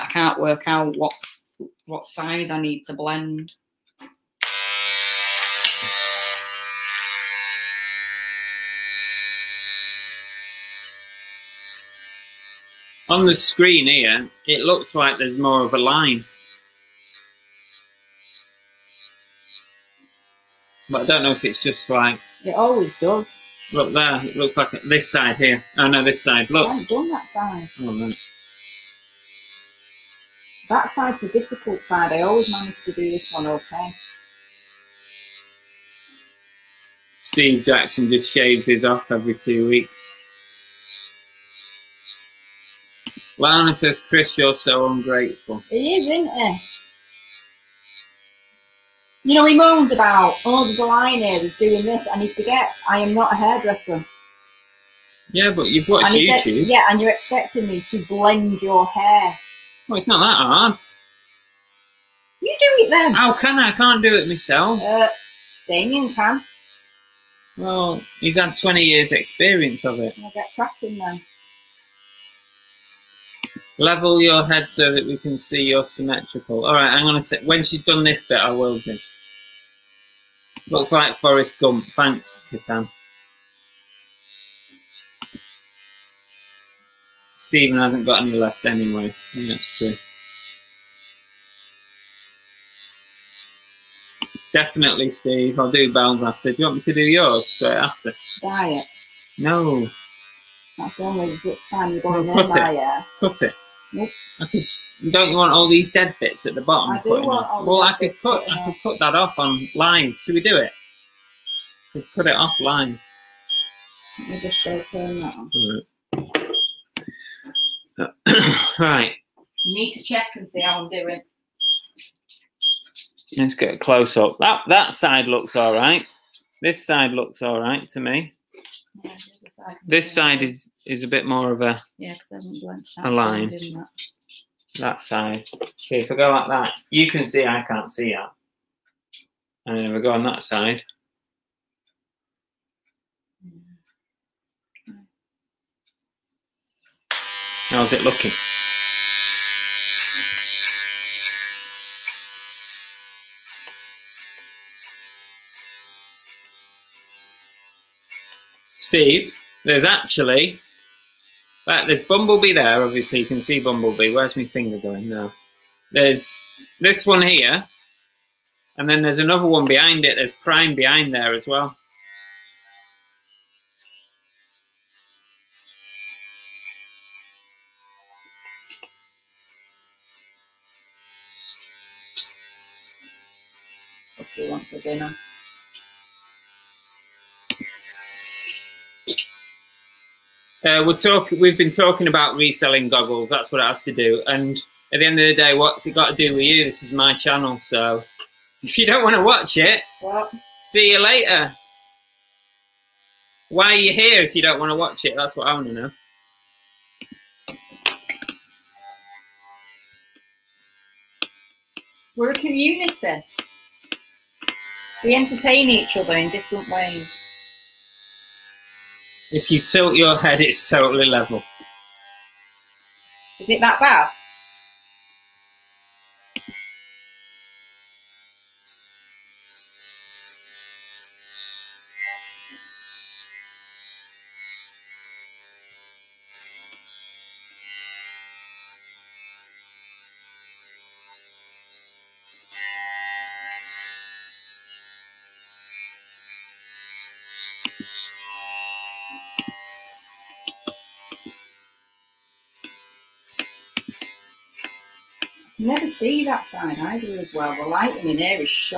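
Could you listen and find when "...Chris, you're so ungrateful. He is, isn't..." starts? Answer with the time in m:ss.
0:44.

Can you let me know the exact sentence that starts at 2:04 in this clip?
That that side looks all right.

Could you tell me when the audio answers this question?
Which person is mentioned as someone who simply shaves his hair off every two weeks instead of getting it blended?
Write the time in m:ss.
0:37.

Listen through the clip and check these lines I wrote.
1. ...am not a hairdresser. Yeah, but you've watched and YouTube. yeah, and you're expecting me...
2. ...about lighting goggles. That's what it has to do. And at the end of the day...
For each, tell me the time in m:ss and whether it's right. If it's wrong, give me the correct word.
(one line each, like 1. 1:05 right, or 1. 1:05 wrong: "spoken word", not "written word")
1. 0:52 right
2. 3:12 wrong: "reselling", not "lighting".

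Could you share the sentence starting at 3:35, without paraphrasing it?
We entertain each other in different ways.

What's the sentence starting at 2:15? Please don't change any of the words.
Okay, if I go like that, you can see I can't see that.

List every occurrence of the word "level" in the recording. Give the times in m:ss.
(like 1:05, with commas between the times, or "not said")
1:13, 3:41.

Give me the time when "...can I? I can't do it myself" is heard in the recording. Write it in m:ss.
1:03.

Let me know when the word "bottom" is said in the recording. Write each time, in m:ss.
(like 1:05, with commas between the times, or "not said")
1:46.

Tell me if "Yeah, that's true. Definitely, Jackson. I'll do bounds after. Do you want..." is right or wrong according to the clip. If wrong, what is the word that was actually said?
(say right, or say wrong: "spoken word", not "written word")
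wrong: "Steve", not "Jackson".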